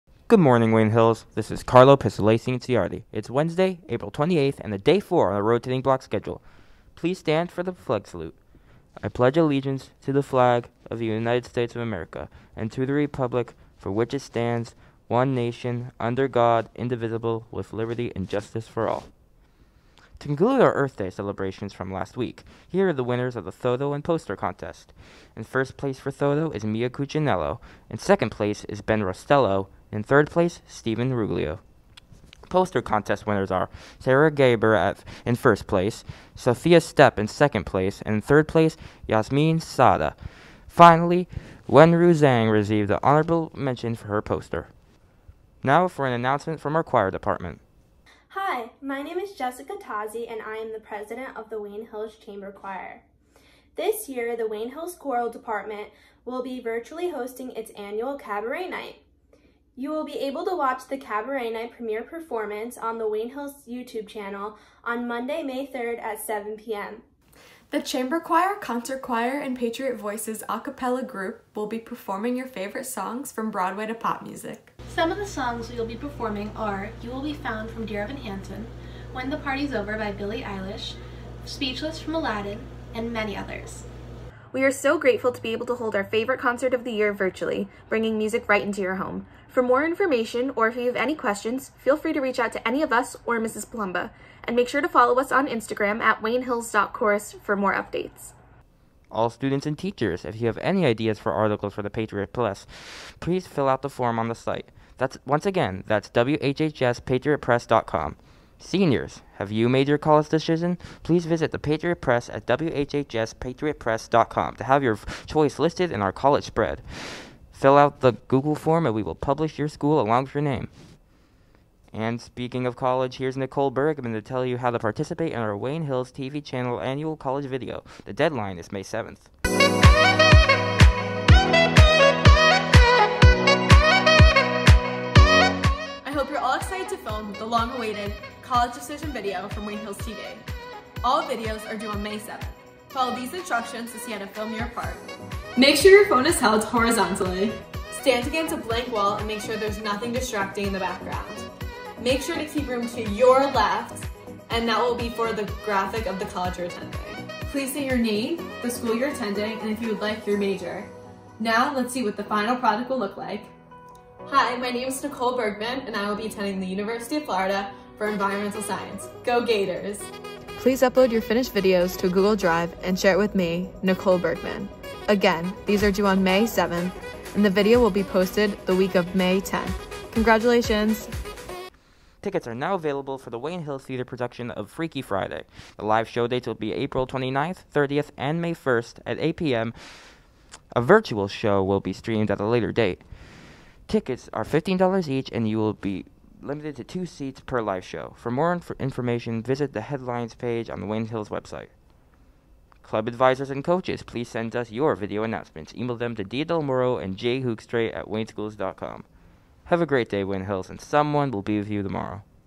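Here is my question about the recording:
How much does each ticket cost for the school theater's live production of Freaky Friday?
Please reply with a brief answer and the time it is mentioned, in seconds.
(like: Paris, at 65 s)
$15, at 194 s.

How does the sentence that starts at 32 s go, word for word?
Poster contest winners are Sarah Gaber at, in first place, Sophia Stepp in second place, and in third place, Yasmin Sada.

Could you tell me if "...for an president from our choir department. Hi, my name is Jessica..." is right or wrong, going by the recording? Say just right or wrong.
wrong.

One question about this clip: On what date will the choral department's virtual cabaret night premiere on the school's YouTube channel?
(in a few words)
Monday, May 3rd.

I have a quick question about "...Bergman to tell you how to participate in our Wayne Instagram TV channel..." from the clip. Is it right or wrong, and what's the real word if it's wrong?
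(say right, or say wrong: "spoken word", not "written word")
wrong: "Hills", not "Instagram".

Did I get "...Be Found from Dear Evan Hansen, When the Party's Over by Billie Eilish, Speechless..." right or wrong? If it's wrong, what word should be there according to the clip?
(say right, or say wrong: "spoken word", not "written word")
right.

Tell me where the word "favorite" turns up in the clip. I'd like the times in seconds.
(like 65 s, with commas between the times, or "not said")
72 s, 86 s.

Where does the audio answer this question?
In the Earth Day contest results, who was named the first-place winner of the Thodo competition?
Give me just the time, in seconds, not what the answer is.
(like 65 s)
26 s.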